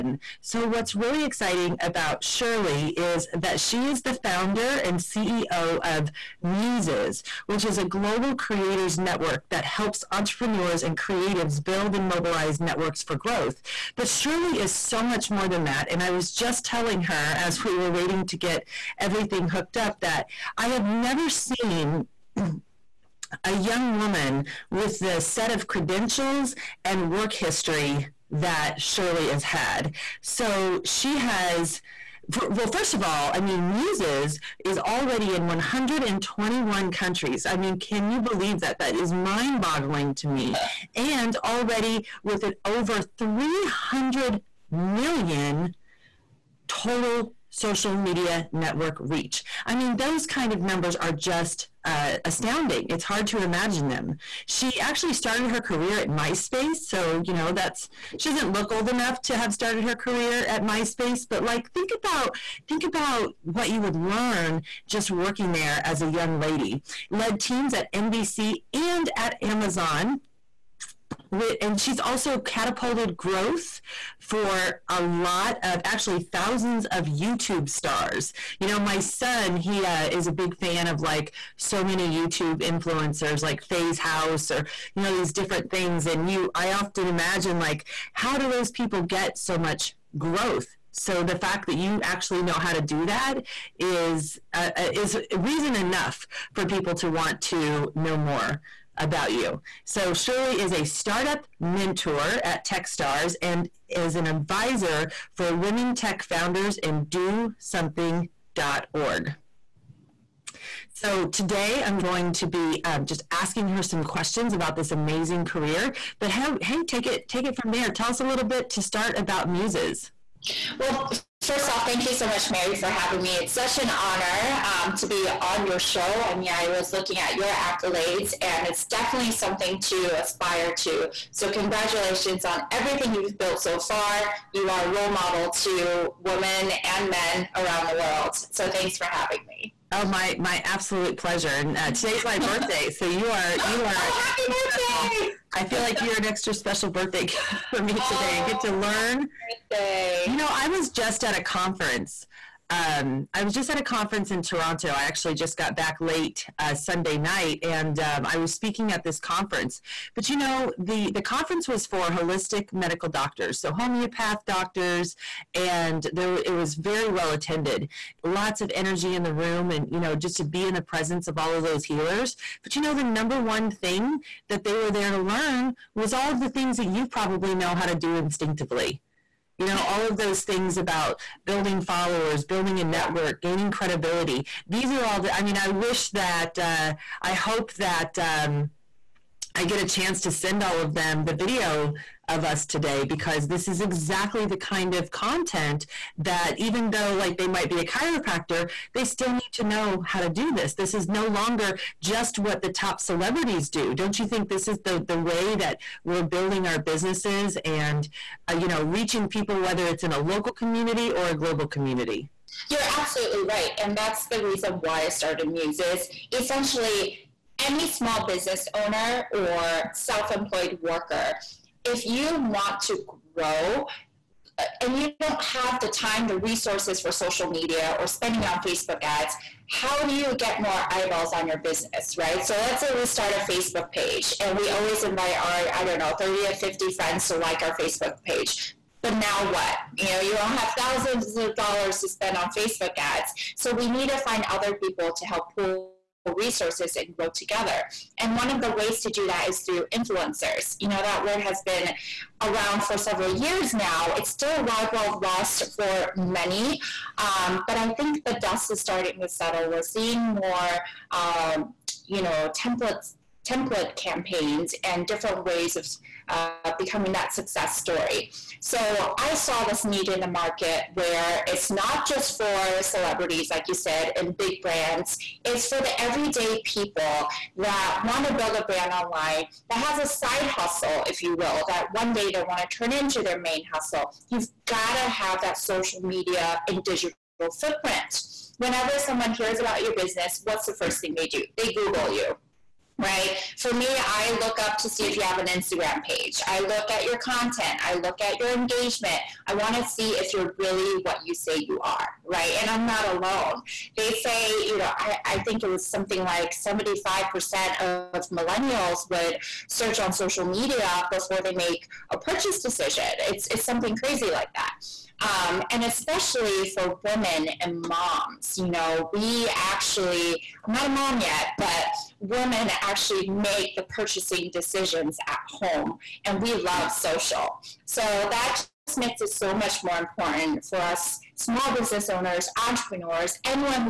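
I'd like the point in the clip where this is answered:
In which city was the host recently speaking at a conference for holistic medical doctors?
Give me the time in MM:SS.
02:34.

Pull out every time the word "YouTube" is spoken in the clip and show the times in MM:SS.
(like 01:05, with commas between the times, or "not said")
01:17, 01:22.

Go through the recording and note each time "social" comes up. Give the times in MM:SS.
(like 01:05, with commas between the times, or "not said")
00:47, 03:47, 04:45, 05:10, 05:26.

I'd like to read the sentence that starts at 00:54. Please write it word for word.
She actually started her career at MySpace.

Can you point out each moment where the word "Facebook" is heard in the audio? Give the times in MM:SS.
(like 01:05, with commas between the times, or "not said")
03:48, 03:53, 03:57, 04:02.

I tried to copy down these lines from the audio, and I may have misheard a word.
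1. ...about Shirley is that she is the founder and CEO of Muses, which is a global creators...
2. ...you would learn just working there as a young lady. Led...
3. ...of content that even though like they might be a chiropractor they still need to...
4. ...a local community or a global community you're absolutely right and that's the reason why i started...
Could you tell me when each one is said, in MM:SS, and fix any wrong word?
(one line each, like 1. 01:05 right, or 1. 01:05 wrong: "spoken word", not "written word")
1. 00:01 right
2. 01:03 right
3. 03:14 right
4. 03:30 right.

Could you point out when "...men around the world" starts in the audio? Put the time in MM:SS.
02:17.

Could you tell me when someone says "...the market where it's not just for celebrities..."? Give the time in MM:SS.
04:30.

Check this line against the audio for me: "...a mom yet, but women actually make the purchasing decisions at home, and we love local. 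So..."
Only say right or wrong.
wrong.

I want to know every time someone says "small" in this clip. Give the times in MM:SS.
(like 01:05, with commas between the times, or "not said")
03:37, 05:31.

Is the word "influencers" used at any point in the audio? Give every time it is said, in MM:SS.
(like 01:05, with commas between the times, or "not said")
01:22, 04:09.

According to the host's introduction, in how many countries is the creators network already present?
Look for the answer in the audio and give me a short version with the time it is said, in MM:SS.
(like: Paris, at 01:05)
121, at 00:35.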